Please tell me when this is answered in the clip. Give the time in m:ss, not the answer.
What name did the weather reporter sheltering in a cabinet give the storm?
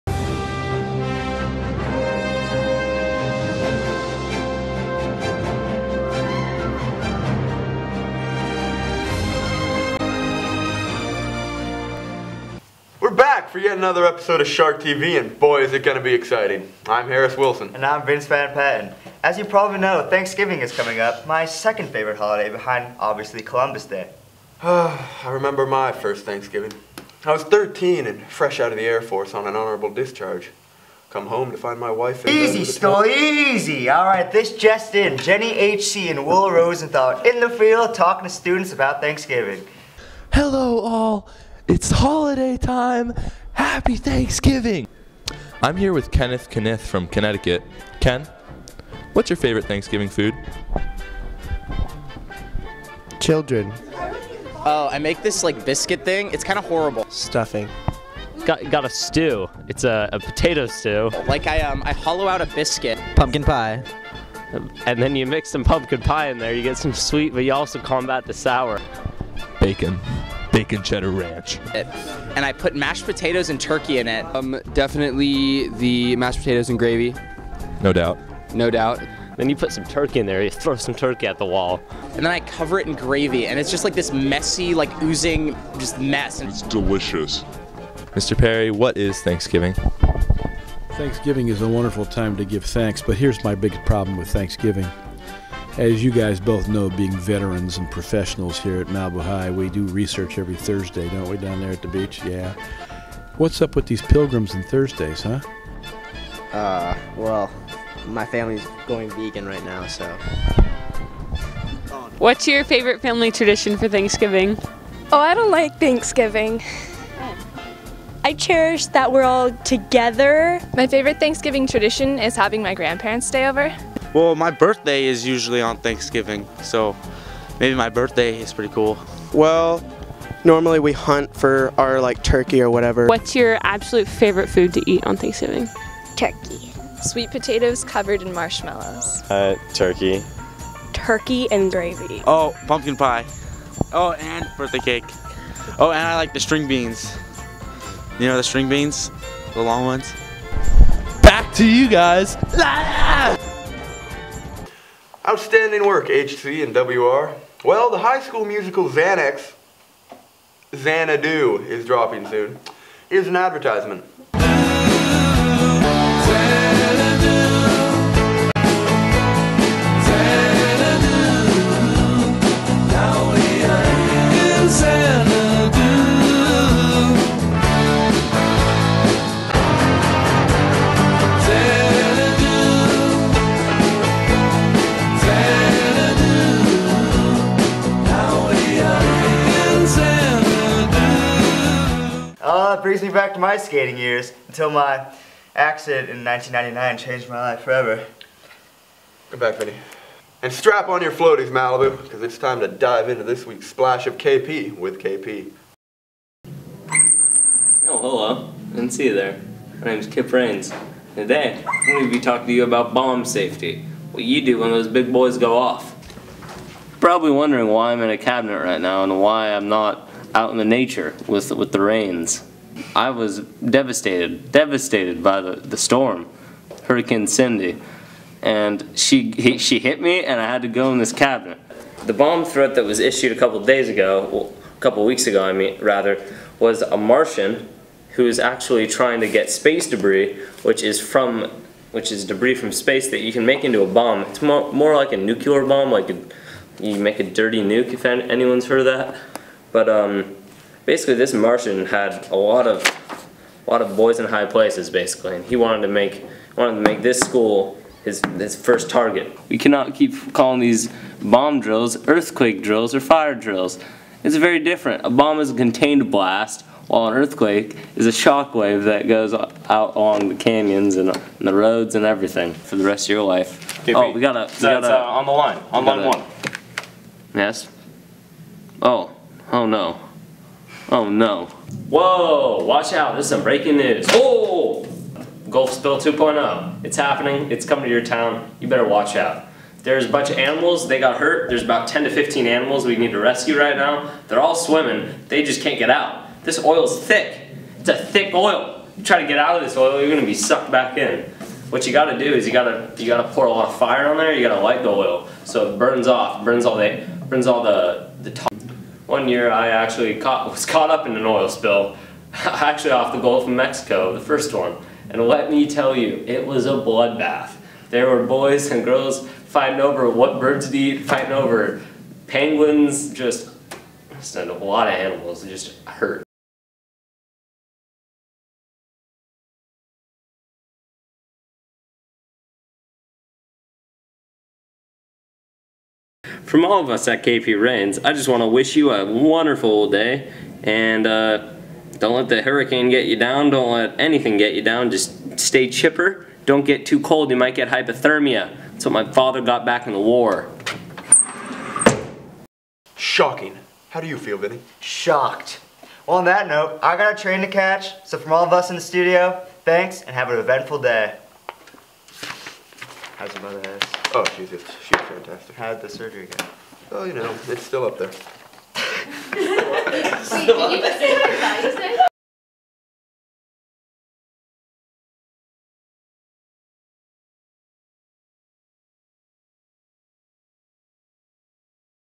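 3:46.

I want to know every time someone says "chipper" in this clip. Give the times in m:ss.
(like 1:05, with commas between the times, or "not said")
5:45.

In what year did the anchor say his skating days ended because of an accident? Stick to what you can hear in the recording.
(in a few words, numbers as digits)
1999.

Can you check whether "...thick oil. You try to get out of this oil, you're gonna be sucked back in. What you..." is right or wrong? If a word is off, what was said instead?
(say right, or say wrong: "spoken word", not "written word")
right.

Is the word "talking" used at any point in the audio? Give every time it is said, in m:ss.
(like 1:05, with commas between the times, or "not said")
0:37, 3:32.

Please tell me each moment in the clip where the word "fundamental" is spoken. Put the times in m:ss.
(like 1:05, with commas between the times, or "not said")
not said.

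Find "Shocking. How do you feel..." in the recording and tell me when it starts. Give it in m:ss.
5:52.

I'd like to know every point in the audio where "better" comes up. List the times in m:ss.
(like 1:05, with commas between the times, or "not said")
4:48.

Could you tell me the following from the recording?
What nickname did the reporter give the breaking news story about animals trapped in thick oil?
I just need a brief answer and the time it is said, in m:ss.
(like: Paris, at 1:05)
Gulf Spill 2.0, at 4:45.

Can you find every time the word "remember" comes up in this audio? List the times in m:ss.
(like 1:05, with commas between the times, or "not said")
0:25.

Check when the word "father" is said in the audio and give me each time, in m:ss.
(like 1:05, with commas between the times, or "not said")
5:49.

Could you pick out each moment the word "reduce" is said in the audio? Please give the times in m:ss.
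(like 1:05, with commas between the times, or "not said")
not said.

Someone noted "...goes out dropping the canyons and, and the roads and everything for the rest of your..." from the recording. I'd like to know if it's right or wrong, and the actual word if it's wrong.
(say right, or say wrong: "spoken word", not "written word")
wrong: "along", not "dropping".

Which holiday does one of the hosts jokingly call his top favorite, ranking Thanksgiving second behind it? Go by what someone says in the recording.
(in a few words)
Columbus Day.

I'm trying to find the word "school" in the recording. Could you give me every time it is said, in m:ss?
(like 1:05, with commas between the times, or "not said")
2:38, 4:17.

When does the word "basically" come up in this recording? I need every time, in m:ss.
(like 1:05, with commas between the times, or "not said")
4:10, 4:14.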